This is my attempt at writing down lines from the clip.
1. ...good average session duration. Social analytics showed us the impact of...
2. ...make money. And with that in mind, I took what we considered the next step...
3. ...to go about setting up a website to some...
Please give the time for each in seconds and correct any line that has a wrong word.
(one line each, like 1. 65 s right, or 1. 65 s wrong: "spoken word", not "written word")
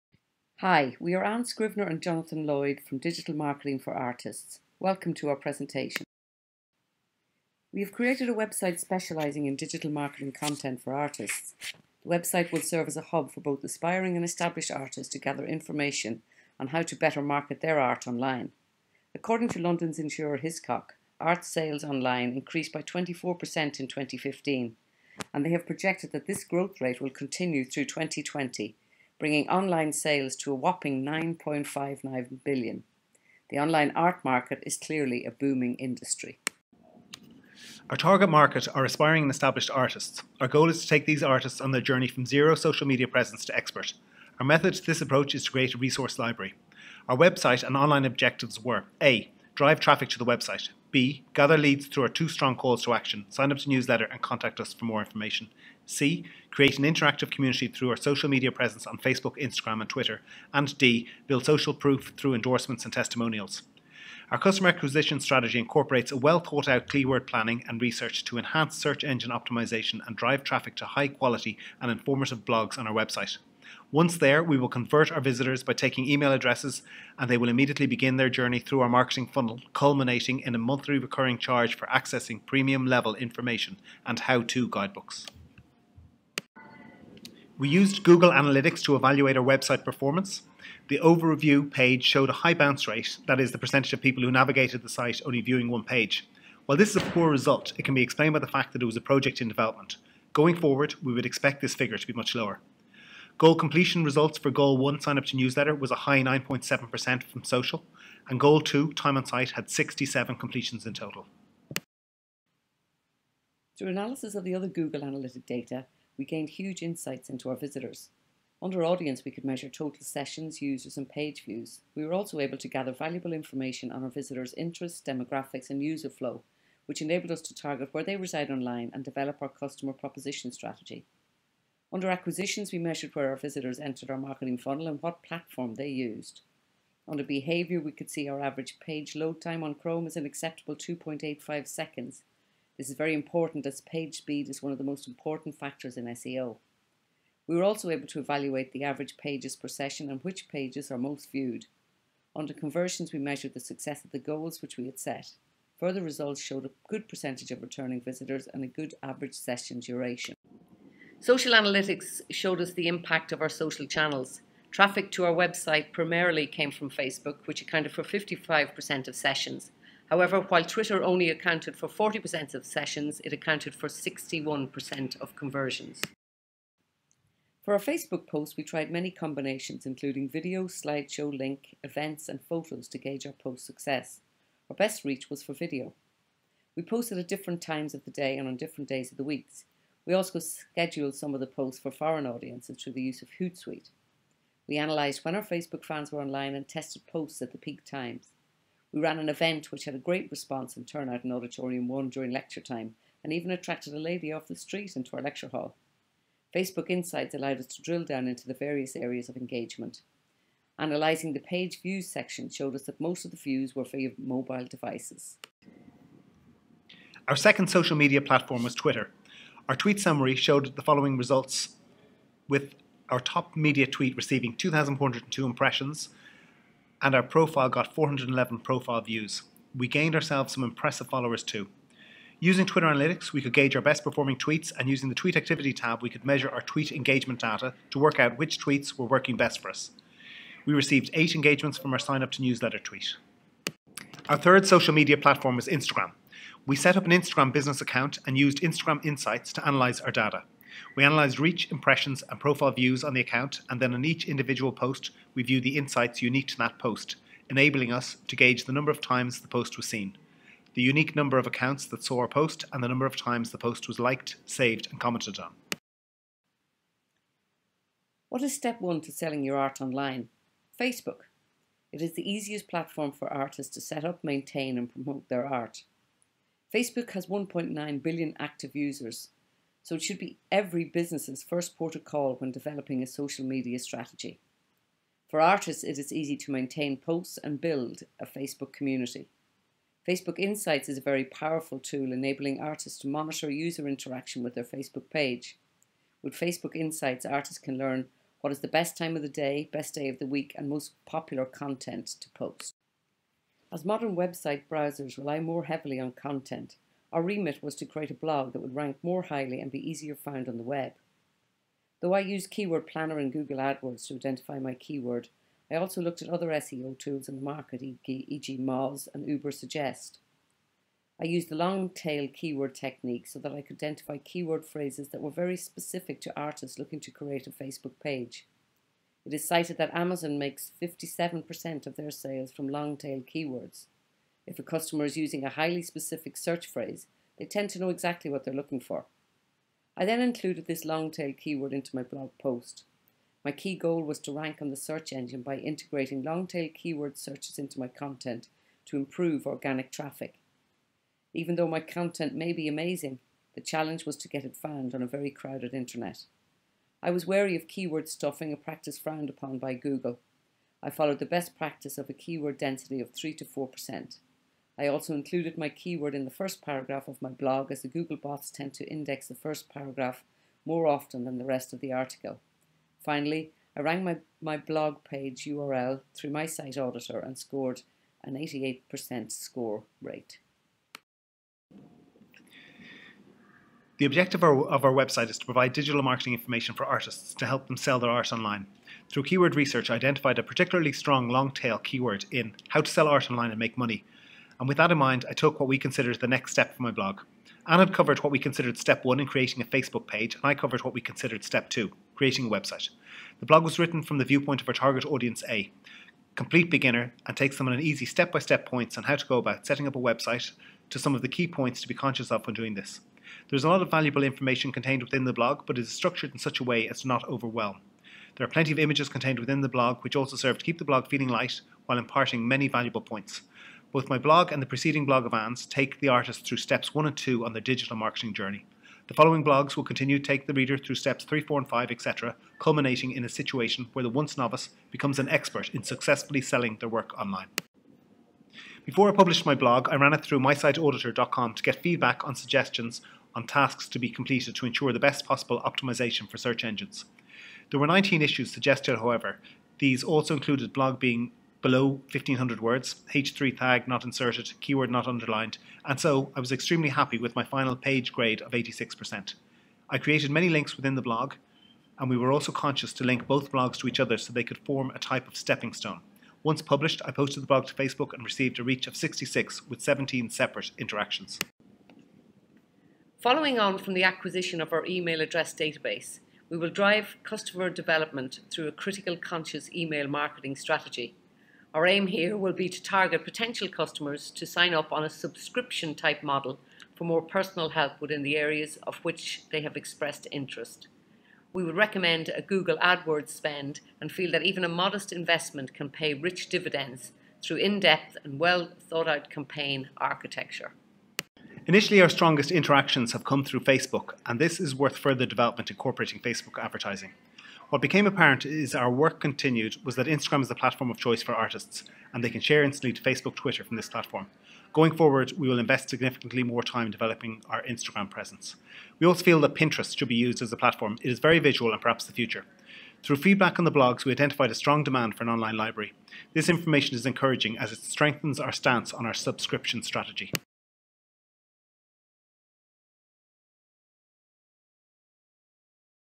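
1. 158 s right
2. 393 s right
3. 409 s right.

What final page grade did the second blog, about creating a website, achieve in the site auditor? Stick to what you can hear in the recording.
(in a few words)
86%.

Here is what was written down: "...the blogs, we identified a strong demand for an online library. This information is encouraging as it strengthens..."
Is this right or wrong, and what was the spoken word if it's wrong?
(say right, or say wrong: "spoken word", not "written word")
right.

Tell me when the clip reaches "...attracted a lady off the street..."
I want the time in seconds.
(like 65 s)
203 s.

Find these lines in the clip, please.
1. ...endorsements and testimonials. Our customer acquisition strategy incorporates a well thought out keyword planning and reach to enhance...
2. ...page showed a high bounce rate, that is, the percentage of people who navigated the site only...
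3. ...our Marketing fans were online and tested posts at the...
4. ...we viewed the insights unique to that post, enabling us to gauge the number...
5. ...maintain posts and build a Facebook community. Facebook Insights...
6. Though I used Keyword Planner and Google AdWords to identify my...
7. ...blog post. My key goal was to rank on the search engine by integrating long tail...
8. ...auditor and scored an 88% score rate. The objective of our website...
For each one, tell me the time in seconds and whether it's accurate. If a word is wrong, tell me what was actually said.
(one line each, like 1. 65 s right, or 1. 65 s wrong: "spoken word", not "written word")
1. 62 s wrong: "research", not "reach"
2. 91 s right
3. 195 s wrong: "Facebook", not "Marketing"
4. 255 s right
5. 286 s right
6. 312 s right
7. 342 s right
8. 376 s right.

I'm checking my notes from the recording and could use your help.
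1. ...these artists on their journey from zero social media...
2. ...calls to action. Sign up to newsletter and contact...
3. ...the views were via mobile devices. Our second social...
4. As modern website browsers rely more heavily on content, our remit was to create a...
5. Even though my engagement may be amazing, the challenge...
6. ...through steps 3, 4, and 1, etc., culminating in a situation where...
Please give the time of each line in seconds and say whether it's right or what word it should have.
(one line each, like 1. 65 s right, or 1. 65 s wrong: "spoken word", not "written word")
1. 41 s right
2. 52 s right
3. 213 s right
4. 303 s right
5. 351 s wrong: "content", not "engagement"
6. 430 s wrong: "5", not "1".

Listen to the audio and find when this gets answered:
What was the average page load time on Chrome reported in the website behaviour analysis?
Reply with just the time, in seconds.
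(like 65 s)
140 s.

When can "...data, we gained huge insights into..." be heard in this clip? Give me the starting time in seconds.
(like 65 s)
115 s.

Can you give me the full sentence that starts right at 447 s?
There were 19 issues suggested, however.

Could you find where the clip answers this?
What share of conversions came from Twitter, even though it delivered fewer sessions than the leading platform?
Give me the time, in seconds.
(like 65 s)
173 s.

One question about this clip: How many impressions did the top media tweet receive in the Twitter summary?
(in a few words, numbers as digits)
2,402.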